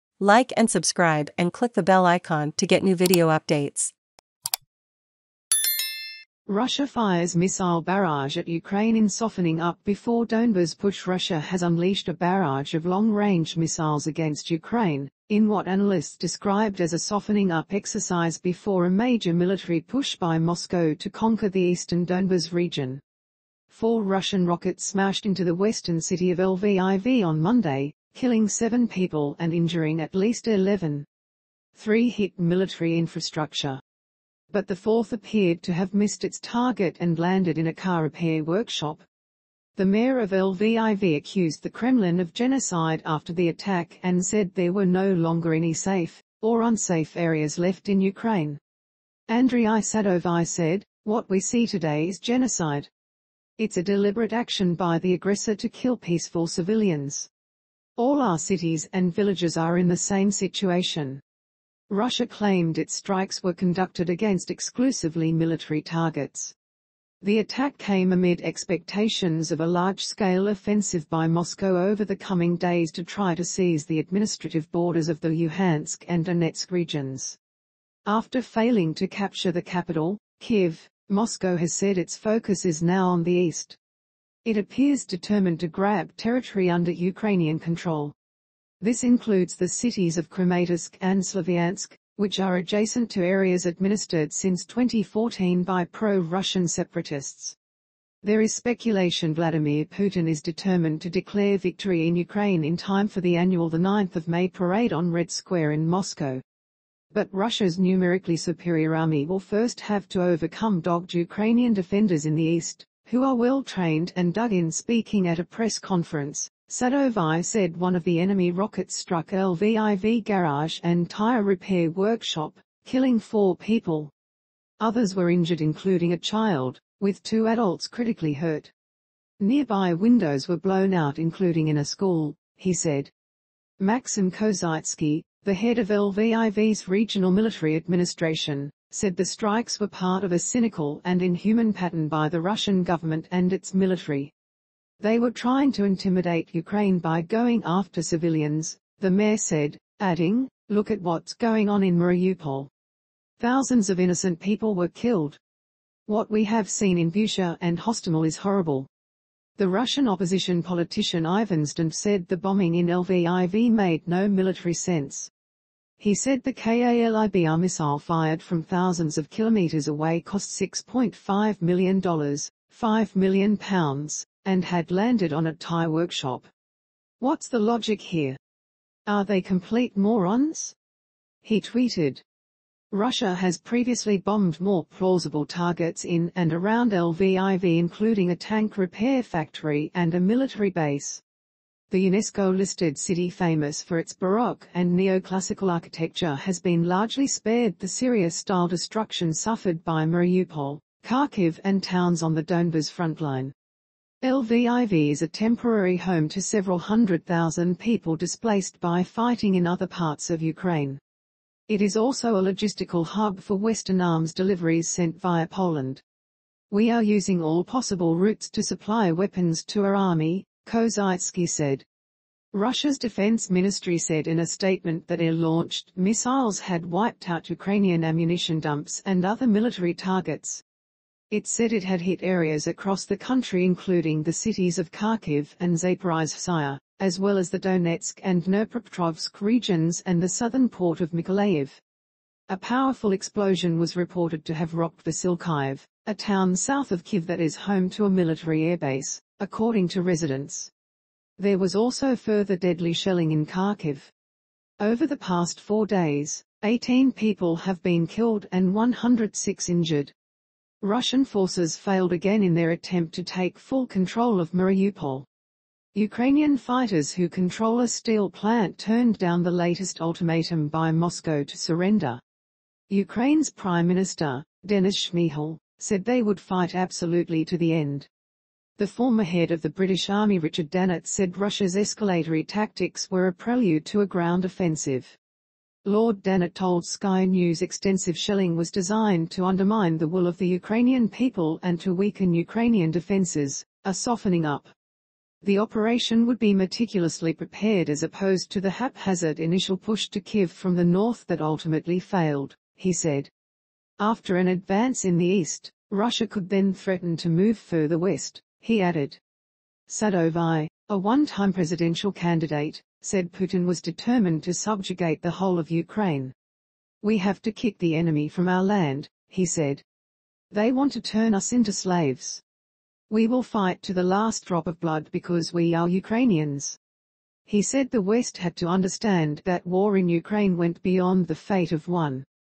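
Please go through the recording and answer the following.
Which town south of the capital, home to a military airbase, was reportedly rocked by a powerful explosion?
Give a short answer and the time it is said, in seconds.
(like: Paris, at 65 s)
Vasilkiv, at 245 s.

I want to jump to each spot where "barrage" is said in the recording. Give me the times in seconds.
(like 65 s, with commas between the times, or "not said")
7 s, 12 s.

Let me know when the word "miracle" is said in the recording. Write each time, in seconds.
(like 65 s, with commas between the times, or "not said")
not said.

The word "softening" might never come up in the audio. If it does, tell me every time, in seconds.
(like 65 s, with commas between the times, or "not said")
9 s, 16 s, 293 s.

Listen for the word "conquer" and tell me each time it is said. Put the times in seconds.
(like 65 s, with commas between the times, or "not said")
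21 s.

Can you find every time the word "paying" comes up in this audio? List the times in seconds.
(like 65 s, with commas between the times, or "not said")
not said.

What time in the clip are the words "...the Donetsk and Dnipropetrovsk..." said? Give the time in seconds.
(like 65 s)
237 s.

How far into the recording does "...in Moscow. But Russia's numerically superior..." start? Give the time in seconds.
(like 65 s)
105 s.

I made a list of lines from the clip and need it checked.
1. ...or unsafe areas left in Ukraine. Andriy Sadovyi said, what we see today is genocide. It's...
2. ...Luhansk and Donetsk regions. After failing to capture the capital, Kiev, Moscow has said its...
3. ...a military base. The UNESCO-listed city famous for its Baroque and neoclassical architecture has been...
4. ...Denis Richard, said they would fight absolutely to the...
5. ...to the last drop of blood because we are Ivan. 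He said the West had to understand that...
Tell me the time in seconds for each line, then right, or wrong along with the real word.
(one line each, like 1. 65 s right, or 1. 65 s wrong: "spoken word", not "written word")
1. 46 s right
2. 75 s right
3. 190 s right
4. 274 s wrong: "Shmyhal", not "Richard"
5. 323 s wrong: "Ukrainians", not "Ivan".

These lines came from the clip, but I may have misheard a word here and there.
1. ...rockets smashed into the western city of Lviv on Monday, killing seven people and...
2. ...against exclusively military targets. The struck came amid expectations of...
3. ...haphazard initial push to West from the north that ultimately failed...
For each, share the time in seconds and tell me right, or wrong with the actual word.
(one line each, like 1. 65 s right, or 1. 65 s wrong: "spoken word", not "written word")
1. 24 s right
2. 64 s wrong: "attack", not "struck"
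3. 298 s wrong: "Kiev", not "West".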